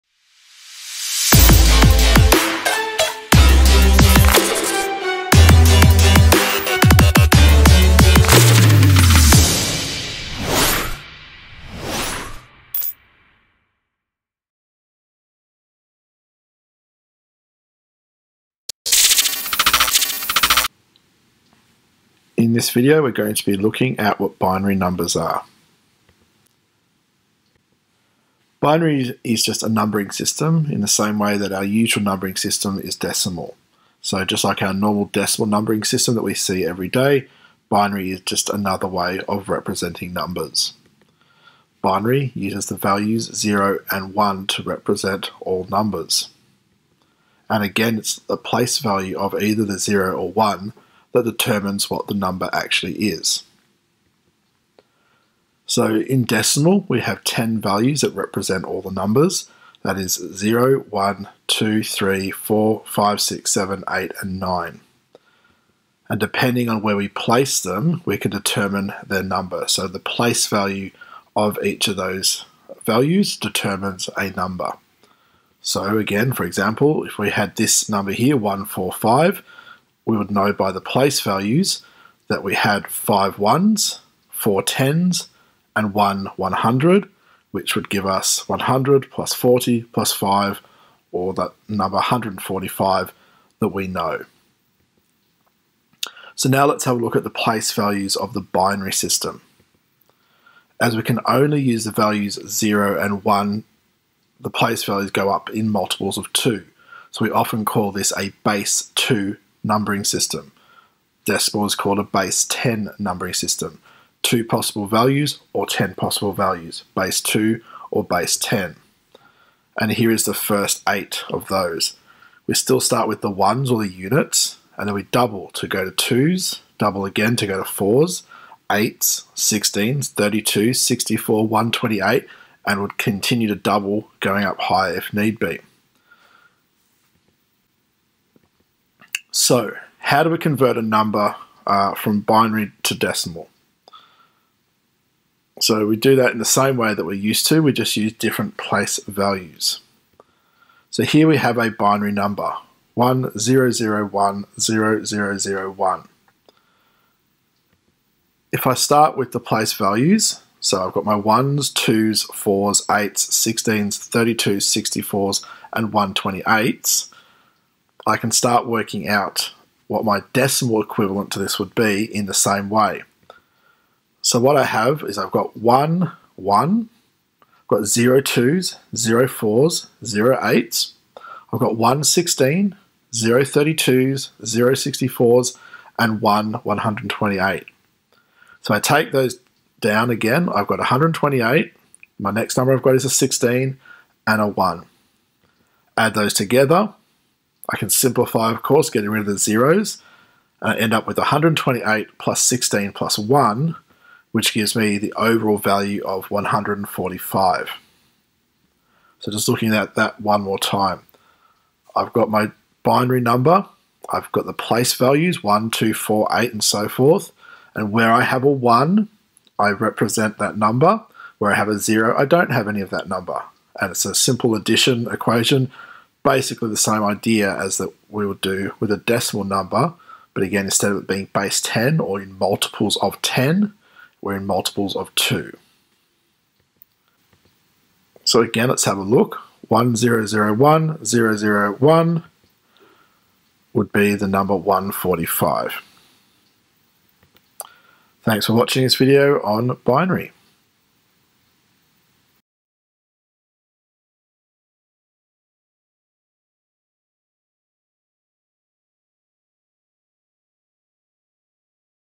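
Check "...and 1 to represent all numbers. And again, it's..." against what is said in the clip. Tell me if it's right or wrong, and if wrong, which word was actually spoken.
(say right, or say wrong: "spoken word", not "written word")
right.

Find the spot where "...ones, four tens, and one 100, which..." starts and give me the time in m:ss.
1:23.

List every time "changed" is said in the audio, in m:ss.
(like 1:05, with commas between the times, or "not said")
not said.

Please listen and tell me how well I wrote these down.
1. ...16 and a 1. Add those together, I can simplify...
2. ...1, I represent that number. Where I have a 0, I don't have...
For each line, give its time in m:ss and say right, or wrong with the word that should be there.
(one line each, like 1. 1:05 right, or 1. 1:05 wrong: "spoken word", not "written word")
1. 3:13 right
2. 3:38 right.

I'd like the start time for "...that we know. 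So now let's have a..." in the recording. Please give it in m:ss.
1:33.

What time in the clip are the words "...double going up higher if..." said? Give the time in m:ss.
2:13.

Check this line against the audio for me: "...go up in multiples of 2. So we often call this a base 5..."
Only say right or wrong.
wrong.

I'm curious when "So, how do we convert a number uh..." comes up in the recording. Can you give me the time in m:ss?
2:19.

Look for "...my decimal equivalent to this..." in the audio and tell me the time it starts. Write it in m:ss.
2:50.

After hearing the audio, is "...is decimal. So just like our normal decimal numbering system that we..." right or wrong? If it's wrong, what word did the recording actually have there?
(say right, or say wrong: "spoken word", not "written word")
right.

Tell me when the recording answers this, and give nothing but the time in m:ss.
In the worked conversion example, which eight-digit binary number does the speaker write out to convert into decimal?
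2:32.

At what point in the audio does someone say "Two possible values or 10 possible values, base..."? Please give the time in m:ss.
1:54.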